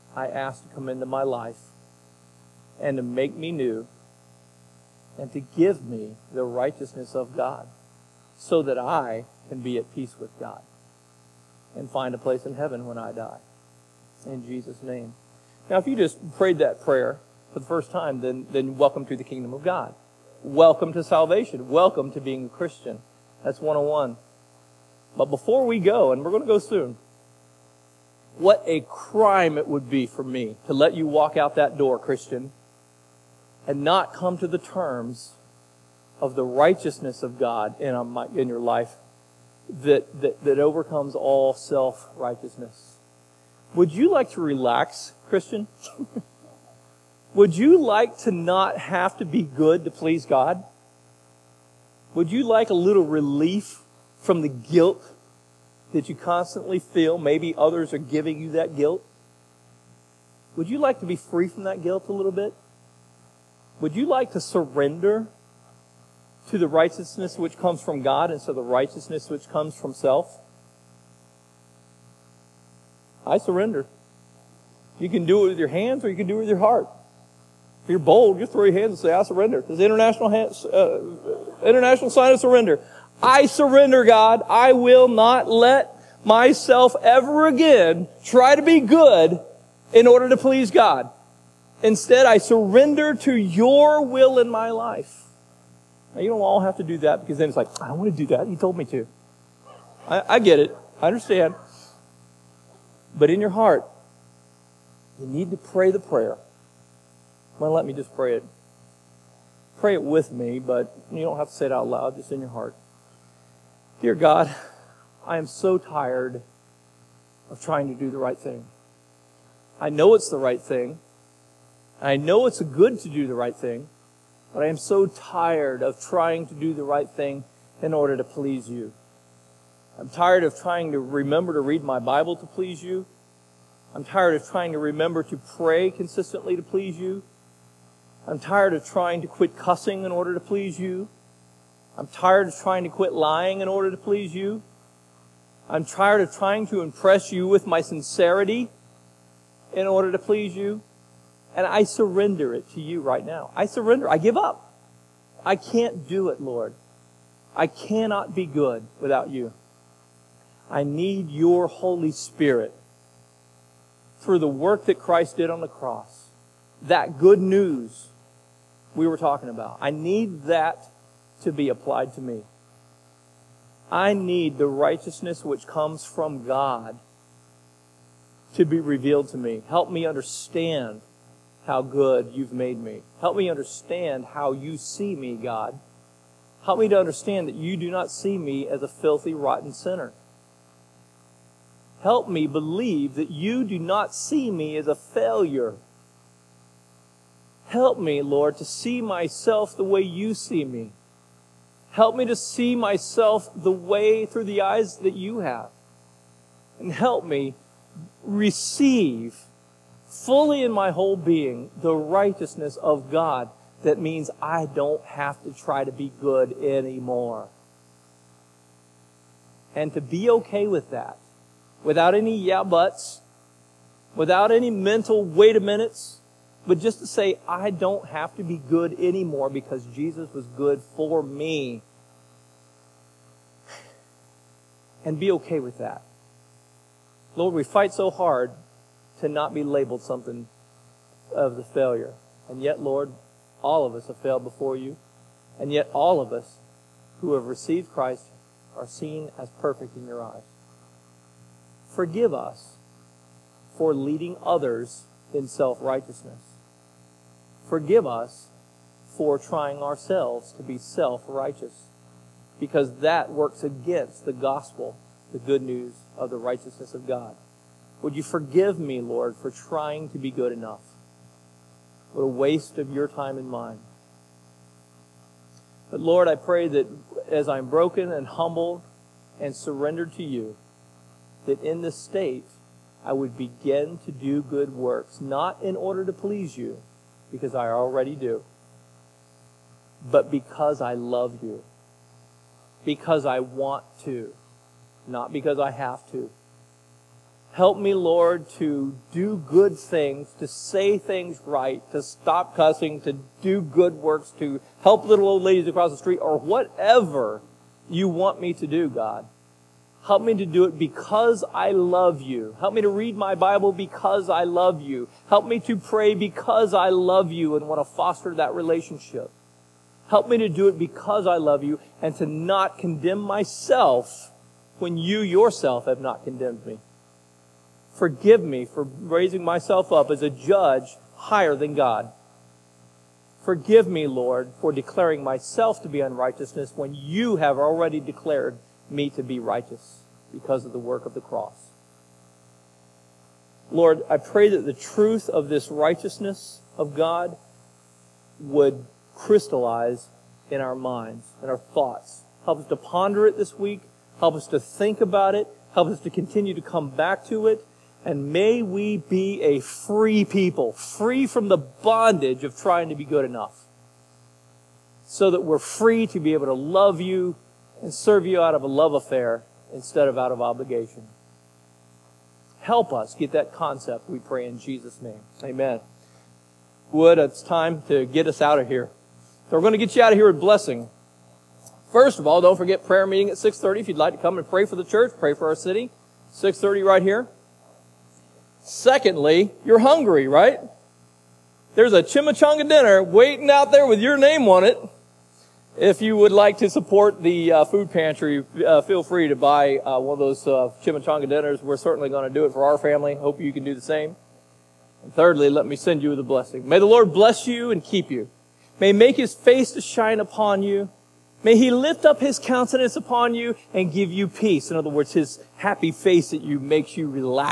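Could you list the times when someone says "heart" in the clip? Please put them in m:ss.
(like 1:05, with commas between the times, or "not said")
1:16, 1:43, 1:52.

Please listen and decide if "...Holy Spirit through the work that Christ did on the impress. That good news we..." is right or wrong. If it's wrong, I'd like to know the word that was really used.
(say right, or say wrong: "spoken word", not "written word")
wrong: "cross", not "impress".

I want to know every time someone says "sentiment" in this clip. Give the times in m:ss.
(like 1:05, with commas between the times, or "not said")
not said.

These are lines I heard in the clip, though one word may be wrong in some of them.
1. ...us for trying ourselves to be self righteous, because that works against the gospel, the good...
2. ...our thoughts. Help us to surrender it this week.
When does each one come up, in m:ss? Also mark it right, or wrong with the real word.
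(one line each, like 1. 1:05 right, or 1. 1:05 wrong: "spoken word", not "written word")
1. 4:18 right
2. 5:51 wrong: "ponder", not "surrender".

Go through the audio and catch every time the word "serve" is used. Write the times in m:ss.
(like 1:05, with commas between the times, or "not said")
6:07.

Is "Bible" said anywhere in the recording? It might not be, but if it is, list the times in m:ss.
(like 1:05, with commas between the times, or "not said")
2:11, 5:13.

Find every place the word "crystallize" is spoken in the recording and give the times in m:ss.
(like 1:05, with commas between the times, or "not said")
5:49.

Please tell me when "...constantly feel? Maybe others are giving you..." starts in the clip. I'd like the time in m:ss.
0:56.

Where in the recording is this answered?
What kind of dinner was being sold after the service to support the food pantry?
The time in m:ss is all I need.
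6:32.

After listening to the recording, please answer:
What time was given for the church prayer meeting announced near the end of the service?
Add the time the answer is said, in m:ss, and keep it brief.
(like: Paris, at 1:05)
6:30, at 6:23.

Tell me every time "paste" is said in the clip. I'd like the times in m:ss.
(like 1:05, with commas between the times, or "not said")
not said.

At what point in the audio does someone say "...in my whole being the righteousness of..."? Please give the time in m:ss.
3:30.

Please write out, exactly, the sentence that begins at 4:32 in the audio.
What a waste of your time and mine.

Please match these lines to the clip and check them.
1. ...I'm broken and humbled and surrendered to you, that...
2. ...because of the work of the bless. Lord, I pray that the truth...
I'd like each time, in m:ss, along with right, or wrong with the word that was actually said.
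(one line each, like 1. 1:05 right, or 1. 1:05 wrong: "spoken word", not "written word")
1. 4:37 right
2. 5:40 wrong: "cross", not "bless".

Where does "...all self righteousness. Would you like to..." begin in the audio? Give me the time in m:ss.
0:41.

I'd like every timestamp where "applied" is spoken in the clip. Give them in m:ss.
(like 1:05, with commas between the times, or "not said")
2:51.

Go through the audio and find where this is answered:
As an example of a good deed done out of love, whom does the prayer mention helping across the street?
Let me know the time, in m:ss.
5:05.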